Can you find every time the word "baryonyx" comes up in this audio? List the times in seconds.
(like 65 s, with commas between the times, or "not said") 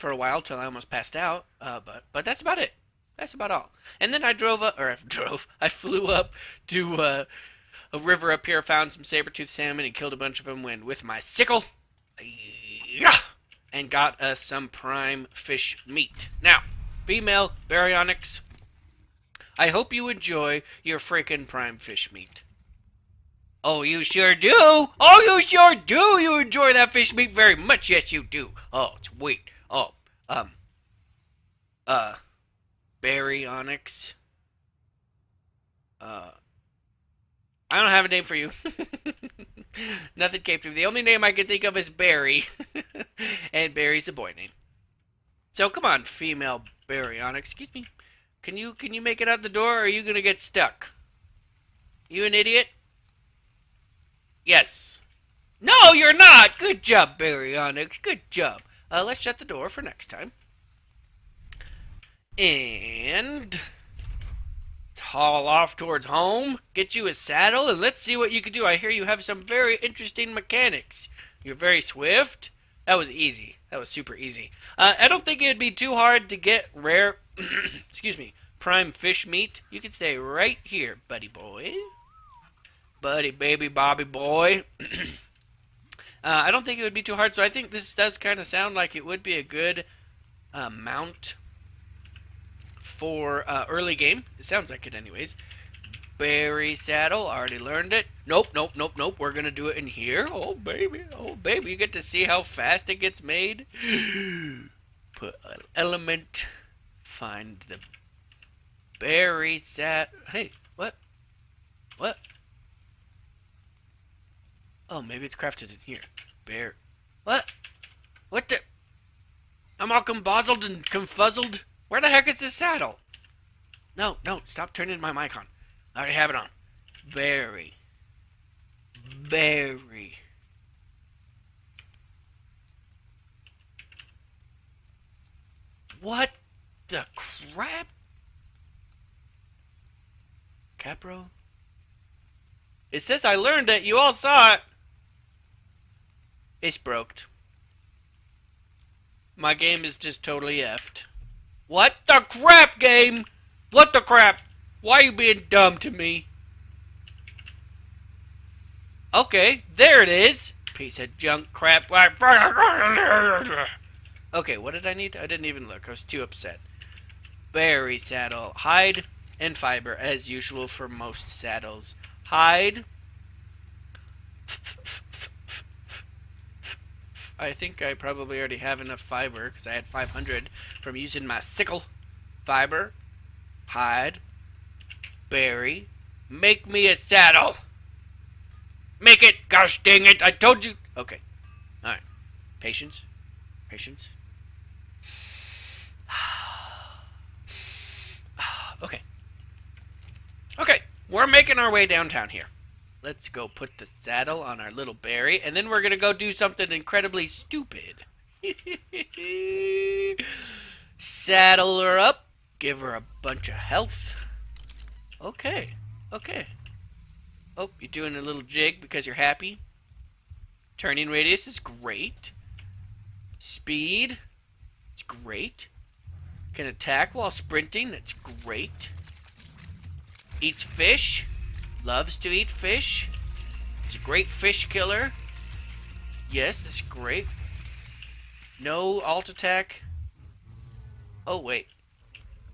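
17 s, 33 s, 46 s, 57 s.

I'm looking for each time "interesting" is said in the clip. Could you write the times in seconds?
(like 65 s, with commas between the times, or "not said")
69 s.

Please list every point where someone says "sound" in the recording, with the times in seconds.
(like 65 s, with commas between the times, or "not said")
88 s, 94 s.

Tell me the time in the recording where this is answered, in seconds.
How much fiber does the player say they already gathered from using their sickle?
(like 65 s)
179 s.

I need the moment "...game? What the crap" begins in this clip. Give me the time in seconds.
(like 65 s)
152 s.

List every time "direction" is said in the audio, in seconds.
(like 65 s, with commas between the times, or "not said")
not said.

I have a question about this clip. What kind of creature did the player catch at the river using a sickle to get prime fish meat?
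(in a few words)
Saber-toothed salmon.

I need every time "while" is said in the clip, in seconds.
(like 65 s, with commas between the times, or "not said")
0 s, 227 s.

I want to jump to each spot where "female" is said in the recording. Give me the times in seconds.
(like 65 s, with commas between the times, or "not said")
17 s, 46 s.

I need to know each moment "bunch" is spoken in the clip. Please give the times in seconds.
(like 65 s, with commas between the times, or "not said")
10 s, 213 s.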